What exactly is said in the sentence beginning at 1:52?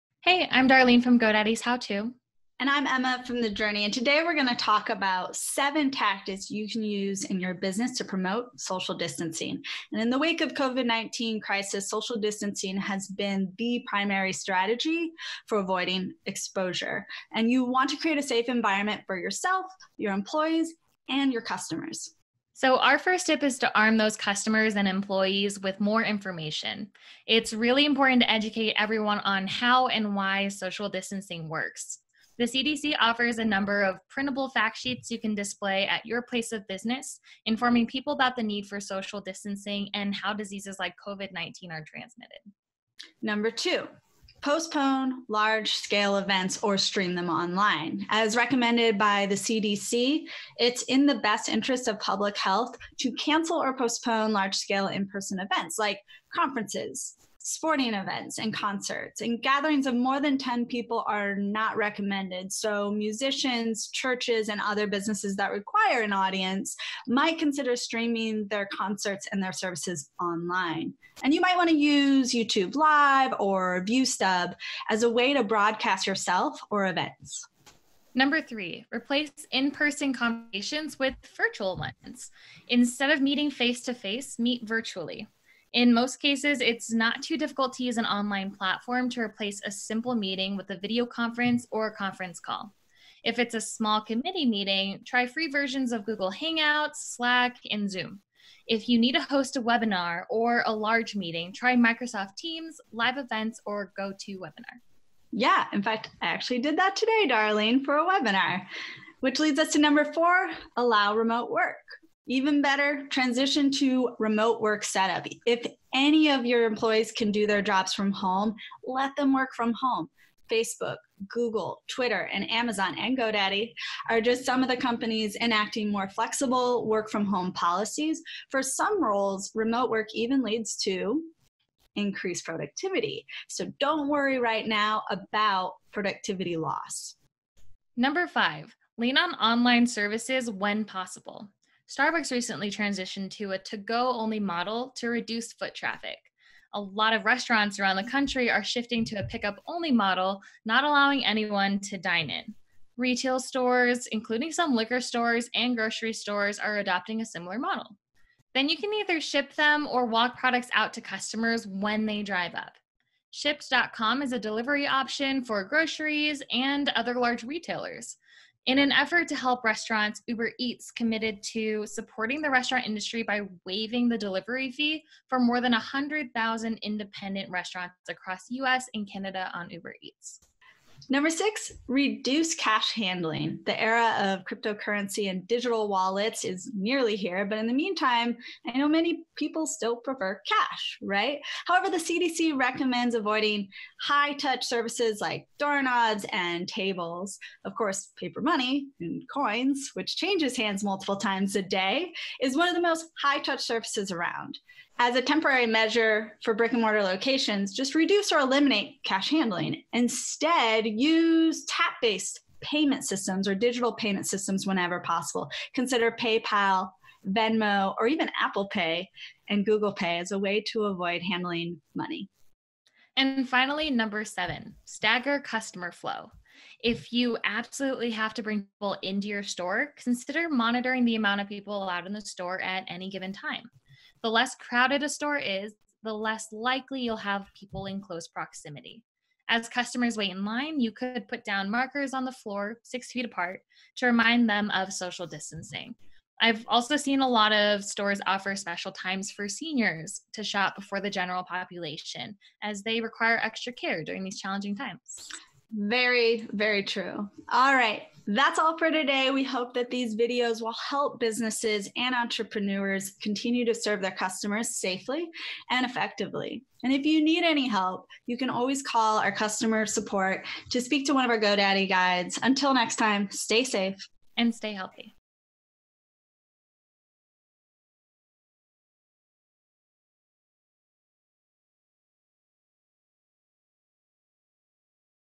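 Even better, transition to remote work setup.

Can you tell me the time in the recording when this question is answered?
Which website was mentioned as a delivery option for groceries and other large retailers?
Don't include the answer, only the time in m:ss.
2:43.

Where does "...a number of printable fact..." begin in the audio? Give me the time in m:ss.
0:33.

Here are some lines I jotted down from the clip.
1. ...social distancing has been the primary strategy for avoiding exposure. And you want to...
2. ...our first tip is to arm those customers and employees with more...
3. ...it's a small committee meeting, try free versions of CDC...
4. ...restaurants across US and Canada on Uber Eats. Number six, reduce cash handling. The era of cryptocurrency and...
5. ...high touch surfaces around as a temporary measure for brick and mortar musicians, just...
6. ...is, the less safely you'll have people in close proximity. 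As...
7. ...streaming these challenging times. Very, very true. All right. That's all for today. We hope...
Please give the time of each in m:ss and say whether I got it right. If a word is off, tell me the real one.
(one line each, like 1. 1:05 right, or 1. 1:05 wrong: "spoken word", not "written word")
1. 0:11 right
2. 0:22 right
3. 1:33 wrong: "Google", not "CDC"
4. 2:57 right
5. 3:23 wrong: "locations", not "musicians"
6. 3:55 wrong: "likely", not "safely"
7. 4:14 wrong: "during", not "streaming".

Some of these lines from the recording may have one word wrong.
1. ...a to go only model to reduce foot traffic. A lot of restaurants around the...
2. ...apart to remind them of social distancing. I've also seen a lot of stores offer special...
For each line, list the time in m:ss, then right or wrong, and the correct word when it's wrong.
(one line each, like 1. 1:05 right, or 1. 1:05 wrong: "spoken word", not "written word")
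1. 2:23 right
2. 4:03 right.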